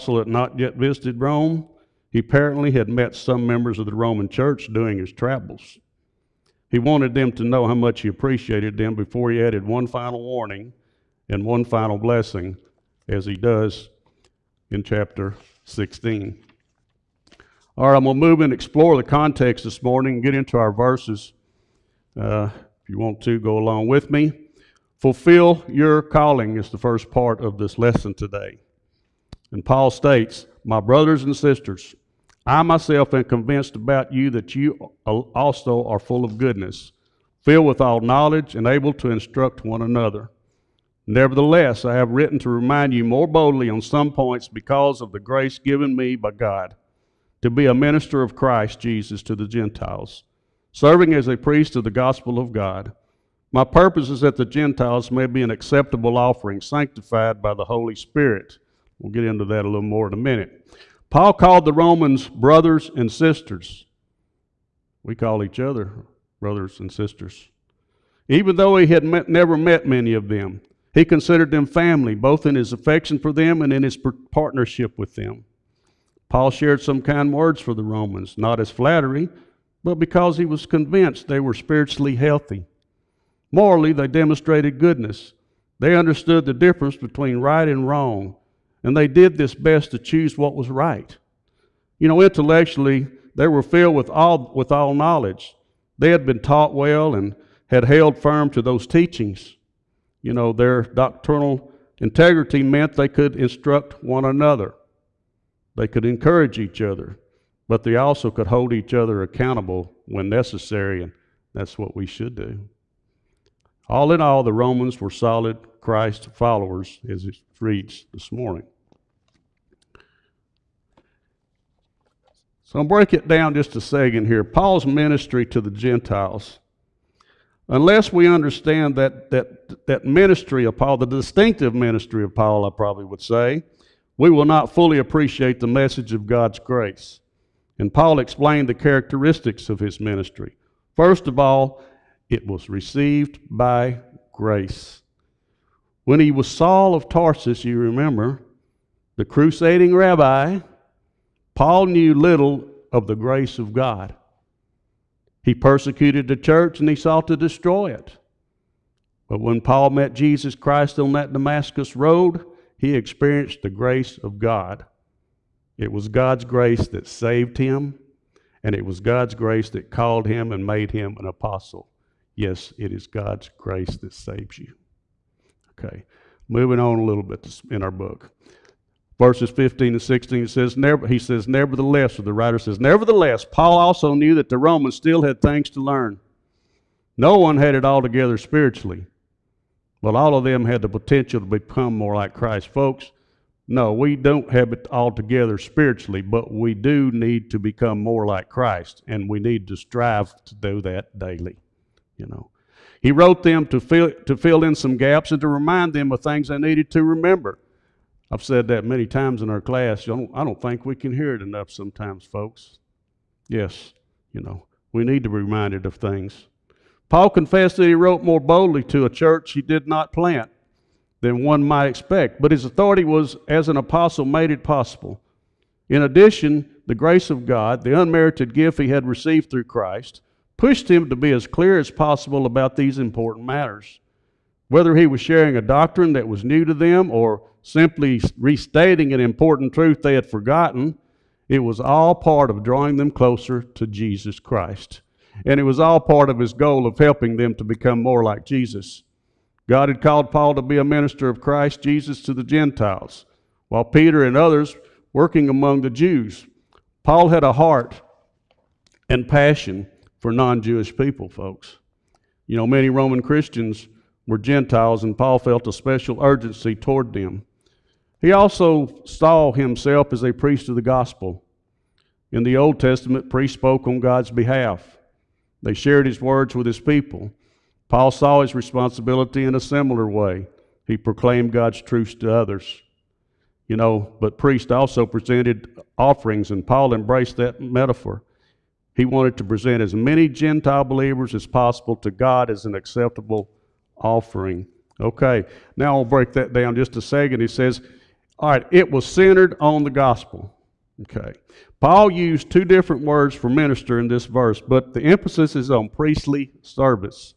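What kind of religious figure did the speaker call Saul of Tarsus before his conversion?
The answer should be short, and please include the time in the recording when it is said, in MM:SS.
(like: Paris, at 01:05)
crusading rabbi, at 02:29.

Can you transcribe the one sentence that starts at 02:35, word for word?
He persecuted the church and he sought to destroy it.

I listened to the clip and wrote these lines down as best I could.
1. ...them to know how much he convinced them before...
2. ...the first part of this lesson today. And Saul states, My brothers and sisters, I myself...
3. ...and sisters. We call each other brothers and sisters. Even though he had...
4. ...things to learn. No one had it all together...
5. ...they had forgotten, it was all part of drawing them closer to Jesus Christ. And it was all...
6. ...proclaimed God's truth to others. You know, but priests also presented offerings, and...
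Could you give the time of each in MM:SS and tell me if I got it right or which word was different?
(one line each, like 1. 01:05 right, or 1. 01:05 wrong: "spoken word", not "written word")
1. 00:07 wrong: "appreciated", not "convinced"
2. 00:26 wrong: "Paul", not "Saul"
3. 01:02 right
4. 03:05 right
5. 04:00 right
6. 04:40 right.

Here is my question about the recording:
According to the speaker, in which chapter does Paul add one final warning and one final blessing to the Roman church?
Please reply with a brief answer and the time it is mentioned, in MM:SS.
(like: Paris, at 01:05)
Chapter 16, at 00:14.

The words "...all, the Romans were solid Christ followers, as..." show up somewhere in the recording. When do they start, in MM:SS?
01:54.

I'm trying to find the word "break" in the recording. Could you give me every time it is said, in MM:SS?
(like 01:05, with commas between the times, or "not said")
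02:02, 04:56.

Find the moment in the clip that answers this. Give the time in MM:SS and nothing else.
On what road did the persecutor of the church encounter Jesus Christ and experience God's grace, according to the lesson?
02:41.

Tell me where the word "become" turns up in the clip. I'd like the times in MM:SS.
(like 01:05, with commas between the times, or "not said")
03:11, 03:17, 04:07.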